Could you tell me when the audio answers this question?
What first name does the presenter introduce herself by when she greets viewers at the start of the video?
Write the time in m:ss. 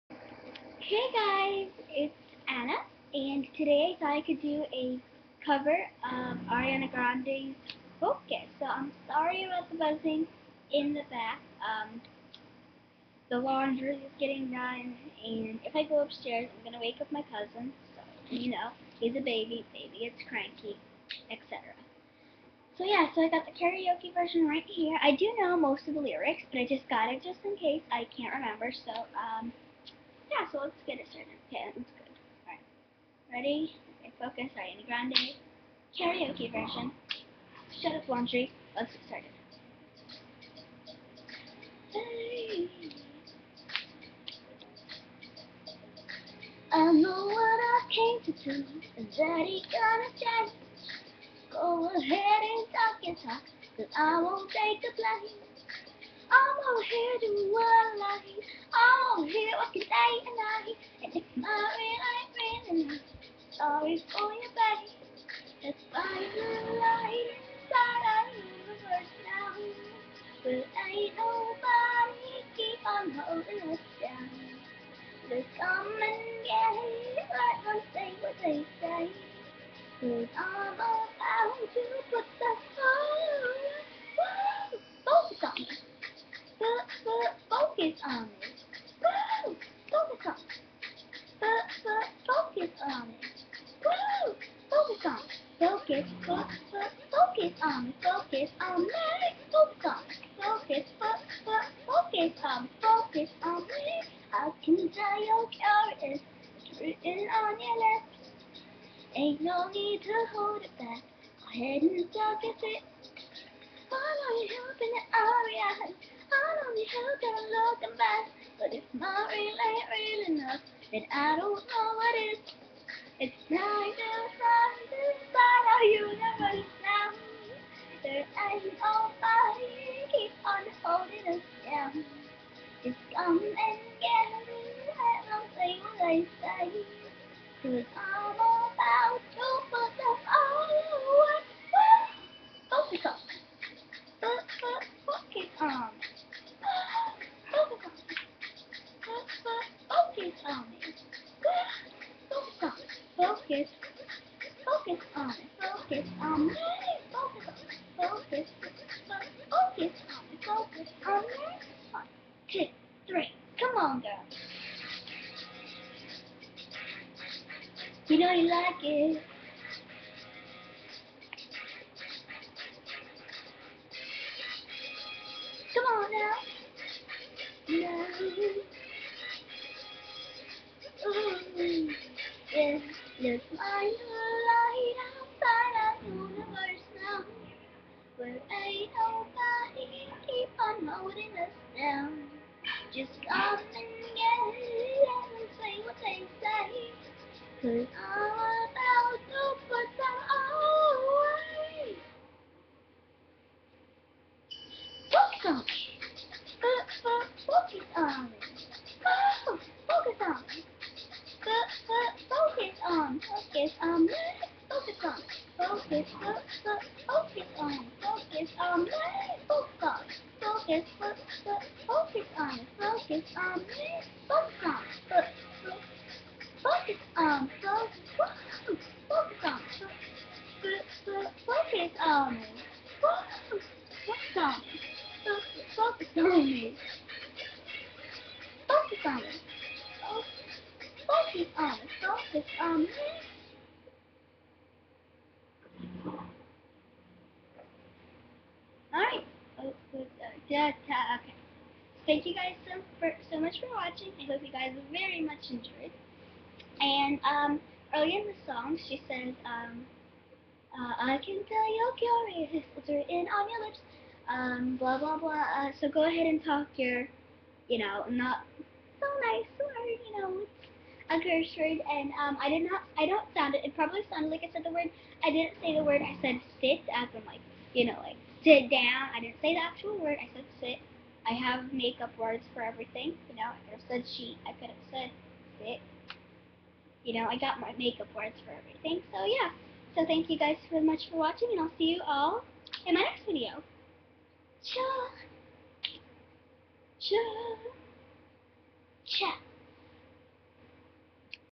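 0:02.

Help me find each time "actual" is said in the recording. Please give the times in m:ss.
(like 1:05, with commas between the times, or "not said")
4:39.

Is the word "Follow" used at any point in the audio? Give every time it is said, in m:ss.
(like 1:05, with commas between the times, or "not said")
1:53.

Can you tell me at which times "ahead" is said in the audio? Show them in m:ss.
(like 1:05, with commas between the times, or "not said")
0:51, 1:51, 4:26.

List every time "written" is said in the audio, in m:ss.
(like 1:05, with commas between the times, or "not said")
1:46, 4:22.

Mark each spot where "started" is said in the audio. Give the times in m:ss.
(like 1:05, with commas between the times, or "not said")
0:31, 0:39.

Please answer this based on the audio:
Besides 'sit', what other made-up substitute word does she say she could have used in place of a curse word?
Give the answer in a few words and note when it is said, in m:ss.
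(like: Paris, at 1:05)
sheet, at 4:44.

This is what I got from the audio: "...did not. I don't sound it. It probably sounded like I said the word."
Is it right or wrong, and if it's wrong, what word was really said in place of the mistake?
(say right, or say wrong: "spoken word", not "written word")
right.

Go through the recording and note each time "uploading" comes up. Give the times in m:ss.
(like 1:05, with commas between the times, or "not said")
not said.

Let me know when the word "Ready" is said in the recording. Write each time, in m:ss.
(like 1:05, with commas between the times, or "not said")
0:33.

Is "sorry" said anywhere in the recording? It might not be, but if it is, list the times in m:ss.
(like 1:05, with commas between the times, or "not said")
0:09, 1:03.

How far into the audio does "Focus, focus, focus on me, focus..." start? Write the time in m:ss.
3:40.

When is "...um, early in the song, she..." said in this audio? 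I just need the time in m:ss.
4:17.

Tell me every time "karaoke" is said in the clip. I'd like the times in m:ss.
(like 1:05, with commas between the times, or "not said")
0:23, 0:35.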